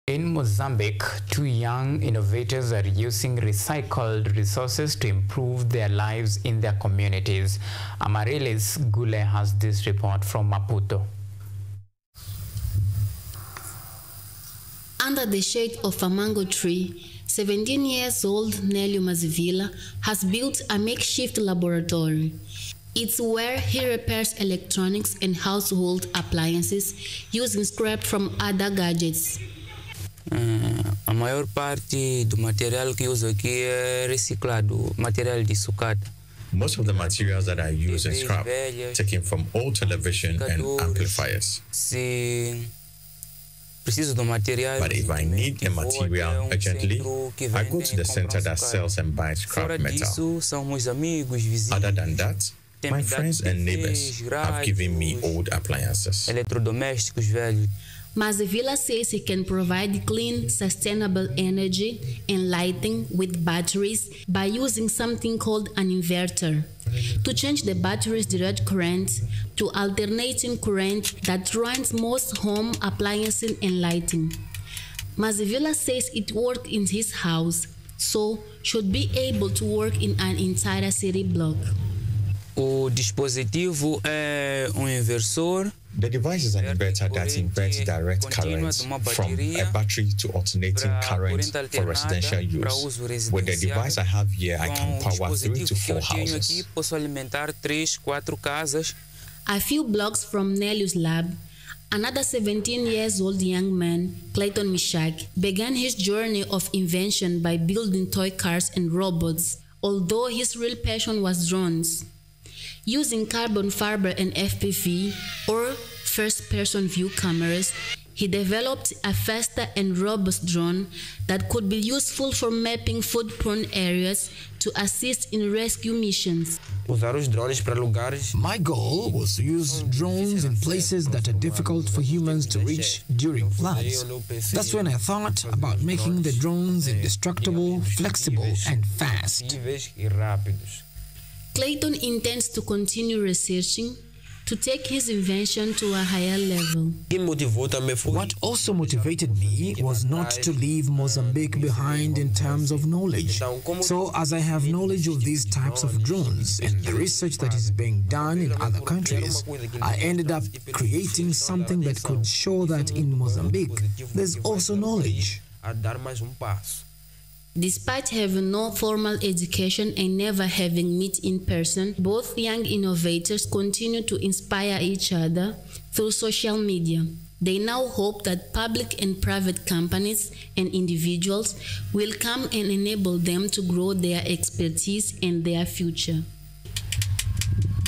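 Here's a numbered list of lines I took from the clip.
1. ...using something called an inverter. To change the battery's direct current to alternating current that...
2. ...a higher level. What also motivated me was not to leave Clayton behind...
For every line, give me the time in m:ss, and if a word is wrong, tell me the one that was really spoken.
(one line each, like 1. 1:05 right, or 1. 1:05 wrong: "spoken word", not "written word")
1. 1:04 right
2. 2:25 wrong: "Mozambique", not "Clayton".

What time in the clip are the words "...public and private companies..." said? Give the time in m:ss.
2:58.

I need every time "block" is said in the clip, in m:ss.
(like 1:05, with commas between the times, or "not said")
1:21, 1:39.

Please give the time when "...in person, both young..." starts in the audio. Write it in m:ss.
2:51.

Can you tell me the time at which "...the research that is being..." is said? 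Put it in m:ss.
2:36.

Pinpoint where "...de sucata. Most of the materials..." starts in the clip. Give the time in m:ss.
0:35.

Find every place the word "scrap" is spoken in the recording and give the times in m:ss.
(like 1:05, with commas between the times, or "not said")
0:27, 0:38, 0:49.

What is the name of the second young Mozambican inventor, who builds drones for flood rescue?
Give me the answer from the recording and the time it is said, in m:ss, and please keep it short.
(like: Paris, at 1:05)
Clayton Mishak, at 1:44.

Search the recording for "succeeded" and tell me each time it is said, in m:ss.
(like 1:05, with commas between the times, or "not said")
not said.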